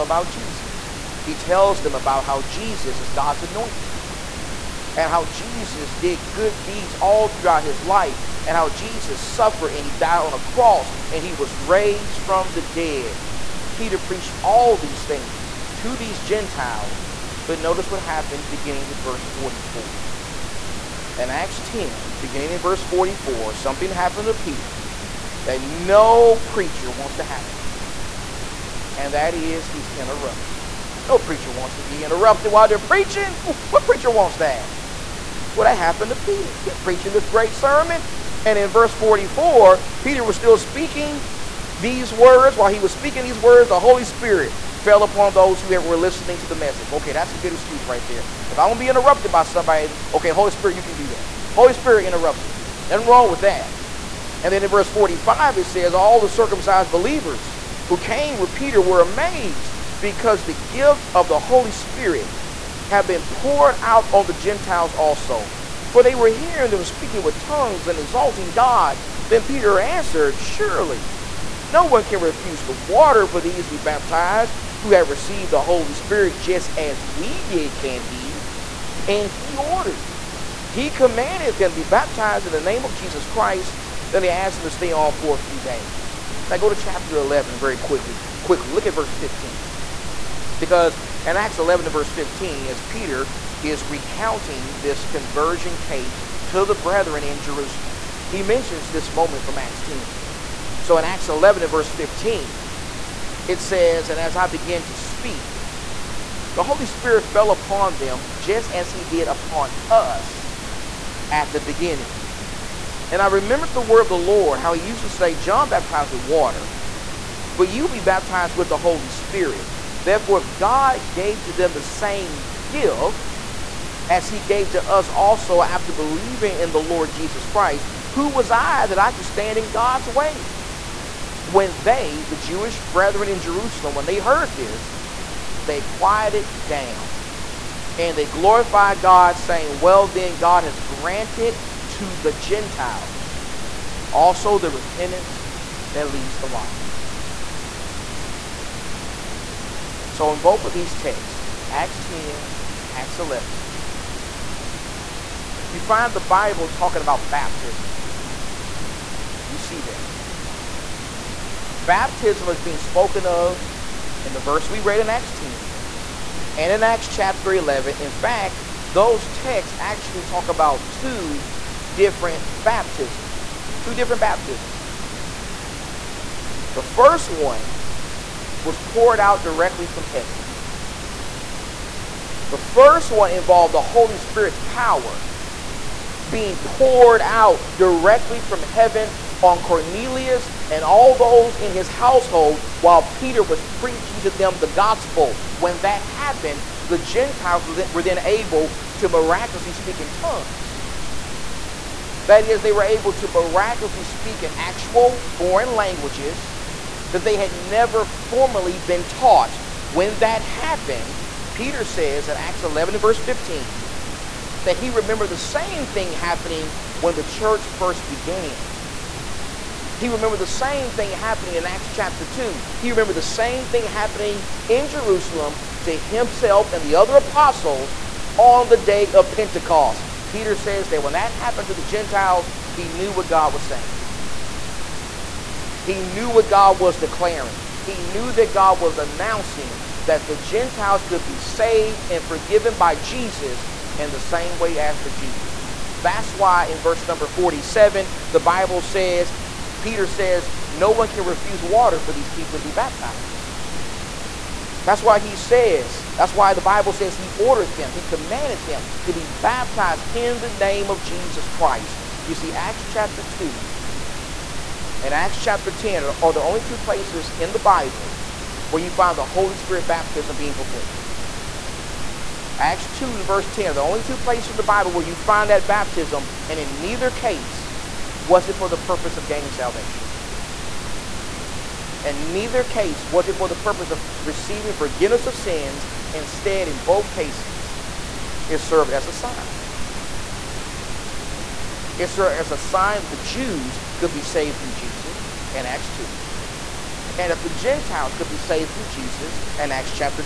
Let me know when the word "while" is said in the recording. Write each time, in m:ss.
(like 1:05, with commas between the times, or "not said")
0:32, 0:42, 3:12.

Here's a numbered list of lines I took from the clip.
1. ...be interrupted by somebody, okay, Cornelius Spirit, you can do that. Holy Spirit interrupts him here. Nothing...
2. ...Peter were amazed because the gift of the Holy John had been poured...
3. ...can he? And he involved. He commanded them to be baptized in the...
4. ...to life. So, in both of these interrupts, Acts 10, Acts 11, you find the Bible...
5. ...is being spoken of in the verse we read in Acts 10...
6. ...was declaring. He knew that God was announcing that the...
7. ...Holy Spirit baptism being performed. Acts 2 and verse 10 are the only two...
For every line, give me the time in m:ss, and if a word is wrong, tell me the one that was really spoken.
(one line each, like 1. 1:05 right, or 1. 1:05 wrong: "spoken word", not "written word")
1. 0:48 wrong: "Holy", not "Cornelius"
2. 0:58 wrong: "Spirit", not "John"
3. 1:17 wrong: "ordered", not "involved"
4. 2:26 wrong: "texts", not "interrupts"
5. 2:42 right
6. 3:56 right
7. 4:29 right.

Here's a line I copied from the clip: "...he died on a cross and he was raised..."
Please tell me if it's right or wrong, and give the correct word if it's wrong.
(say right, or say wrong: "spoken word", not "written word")
right.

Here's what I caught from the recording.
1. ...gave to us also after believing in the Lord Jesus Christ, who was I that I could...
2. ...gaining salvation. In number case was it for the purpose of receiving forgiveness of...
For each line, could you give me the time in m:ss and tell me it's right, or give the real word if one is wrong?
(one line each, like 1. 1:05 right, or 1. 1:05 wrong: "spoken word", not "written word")
1. 2:04 right
2. 4:39 wrong: "neither", not "number".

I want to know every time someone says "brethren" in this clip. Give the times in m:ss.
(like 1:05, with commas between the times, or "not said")
1:36, 2:12.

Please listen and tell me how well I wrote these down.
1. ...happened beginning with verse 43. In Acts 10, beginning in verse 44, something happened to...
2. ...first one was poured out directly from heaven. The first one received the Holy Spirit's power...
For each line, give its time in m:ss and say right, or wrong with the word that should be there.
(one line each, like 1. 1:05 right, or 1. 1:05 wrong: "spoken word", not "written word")
1. 0:17 wrong: "44", not "43"
2. 2:56 wrong: "involved", not "received".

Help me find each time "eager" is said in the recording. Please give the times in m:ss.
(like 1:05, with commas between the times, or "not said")
not said.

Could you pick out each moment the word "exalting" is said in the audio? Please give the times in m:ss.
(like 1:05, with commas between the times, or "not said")
1:07.